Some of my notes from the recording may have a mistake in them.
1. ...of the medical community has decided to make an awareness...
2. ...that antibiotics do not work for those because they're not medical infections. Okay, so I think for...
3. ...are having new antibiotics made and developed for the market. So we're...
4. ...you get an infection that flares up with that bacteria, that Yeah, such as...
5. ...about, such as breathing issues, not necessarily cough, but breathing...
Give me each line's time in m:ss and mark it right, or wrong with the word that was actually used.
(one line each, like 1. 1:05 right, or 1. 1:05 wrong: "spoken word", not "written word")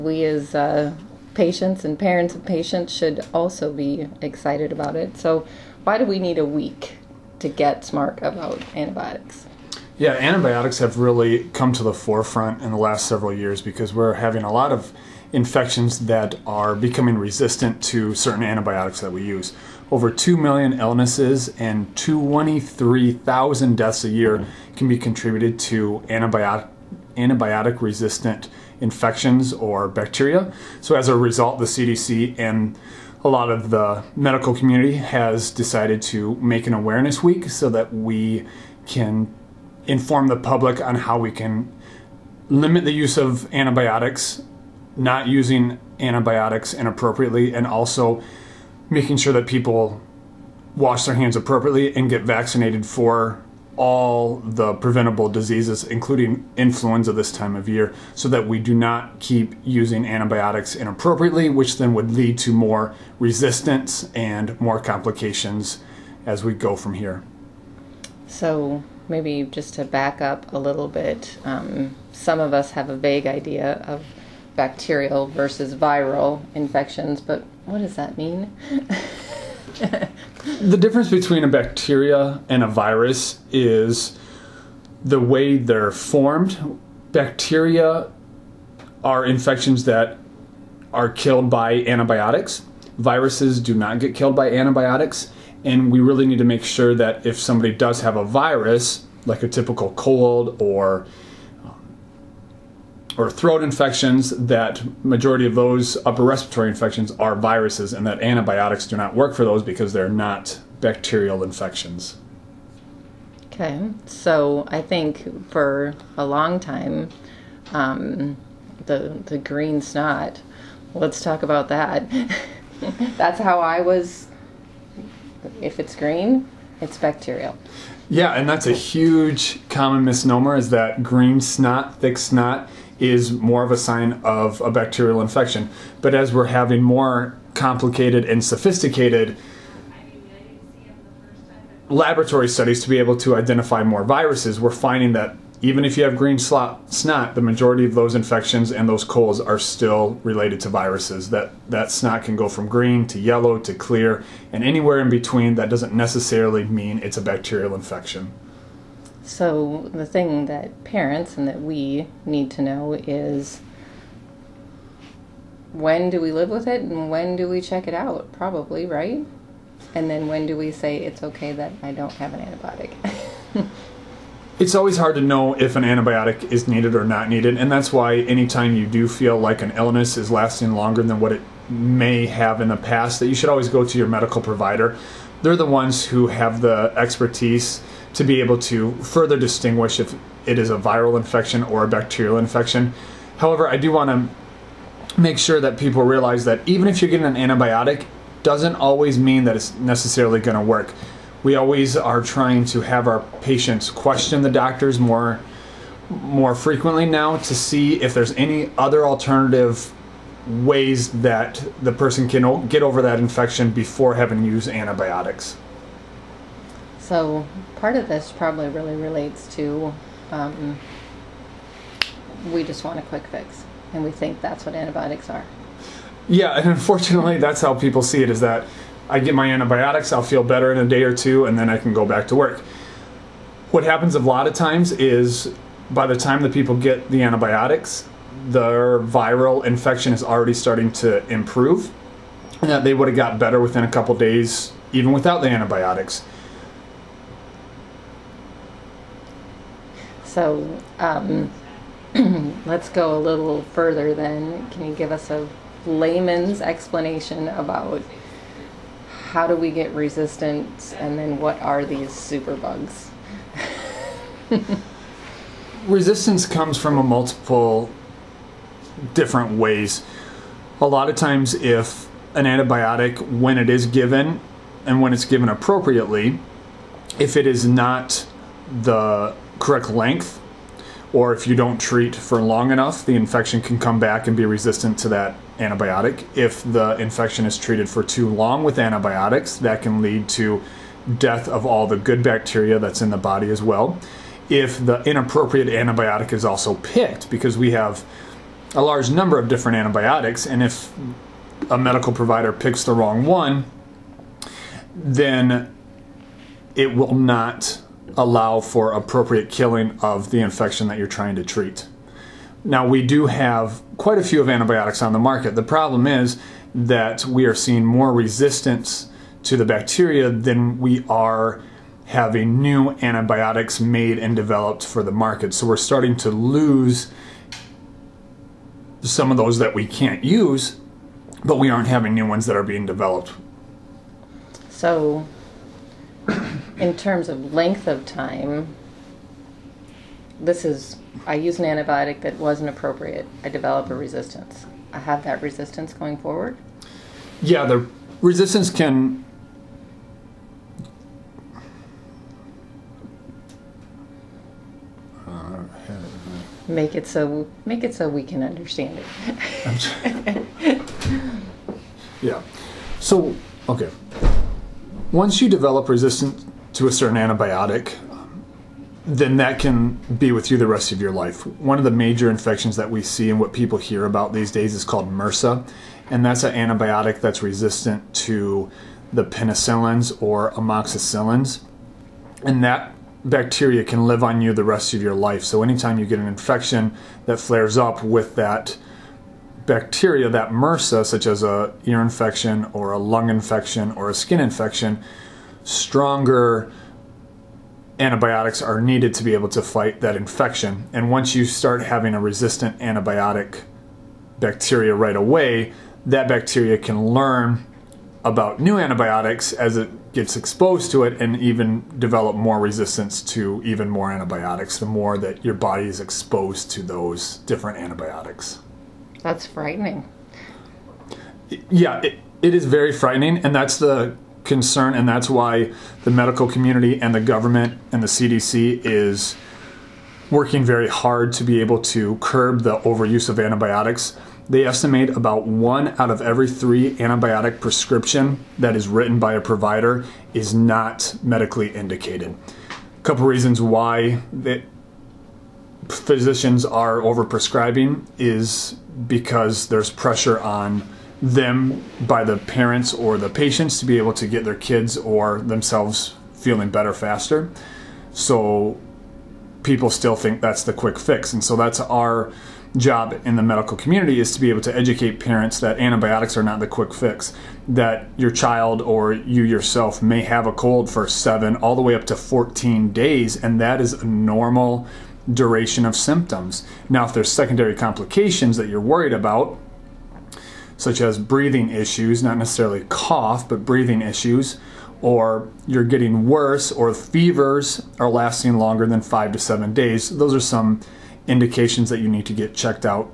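1. 0:33 right
2. 1:48 wrong: "bacterial", not "medical"
3. 5:21 right
4. 6:25 wrong: "MRSA", not "Yeah"
5. 7:59 right.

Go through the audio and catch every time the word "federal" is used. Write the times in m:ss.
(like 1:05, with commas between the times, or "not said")
not said.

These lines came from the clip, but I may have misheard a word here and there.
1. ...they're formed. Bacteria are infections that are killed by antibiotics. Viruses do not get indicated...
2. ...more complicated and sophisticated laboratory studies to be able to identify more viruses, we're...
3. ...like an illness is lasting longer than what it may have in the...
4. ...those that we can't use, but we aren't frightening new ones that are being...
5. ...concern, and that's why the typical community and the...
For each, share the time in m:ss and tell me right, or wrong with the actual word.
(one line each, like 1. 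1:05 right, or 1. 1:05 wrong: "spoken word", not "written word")
1. 1:25 wrong: "killed", not "indicated"
2. 2:16 right
3. 2:59 right
4. 5:29 wrong: "having", not "frightening"
5. 7:04 wrong: "medical", not "typical".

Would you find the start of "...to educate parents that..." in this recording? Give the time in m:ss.
7:44.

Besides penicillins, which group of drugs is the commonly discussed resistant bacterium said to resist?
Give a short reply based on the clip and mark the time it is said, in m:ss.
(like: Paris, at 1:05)
Amoxicillins, at 6:20.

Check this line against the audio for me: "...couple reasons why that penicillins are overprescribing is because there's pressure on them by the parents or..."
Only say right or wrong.
wrong.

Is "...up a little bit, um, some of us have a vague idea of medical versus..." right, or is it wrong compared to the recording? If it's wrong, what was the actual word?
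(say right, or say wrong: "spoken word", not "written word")
wrong: "bacterial", not "medical".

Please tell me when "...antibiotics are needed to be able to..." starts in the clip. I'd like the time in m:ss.
6:37.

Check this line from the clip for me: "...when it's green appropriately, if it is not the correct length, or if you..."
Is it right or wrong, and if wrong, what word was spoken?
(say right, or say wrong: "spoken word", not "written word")
wrong: "given", not "green".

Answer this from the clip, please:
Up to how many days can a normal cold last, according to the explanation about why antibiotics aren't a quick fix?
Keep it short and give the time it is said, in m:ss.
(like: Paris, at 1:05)
14, at 7:52.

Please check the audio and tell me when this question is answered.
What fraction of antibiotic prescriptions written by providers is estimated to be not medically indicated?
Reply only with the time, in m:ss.
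7:15.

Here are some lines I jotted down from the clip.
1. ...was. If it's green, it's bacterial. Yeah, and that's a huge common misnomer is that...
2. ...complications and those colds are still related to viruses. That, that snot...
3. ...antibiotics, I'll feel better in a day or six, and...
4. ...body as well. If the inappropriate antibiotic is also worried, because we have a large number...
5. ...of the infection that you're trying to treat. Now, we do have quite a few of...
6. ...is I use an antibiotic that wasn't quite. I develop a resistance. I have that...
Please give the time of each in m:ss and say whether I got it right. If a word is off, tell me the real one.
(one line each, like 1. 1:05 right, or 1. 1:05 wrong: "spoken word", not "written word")
1. 2:03 right
2. 2:28 wrong: "infections", not "complications"
3. 3:49 wrong: "two", not "six"
4. 4:53 wrong: "picked", not "worried"
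5. 5:10 right
6. 5:40 wrong: "appropriate", not "quite".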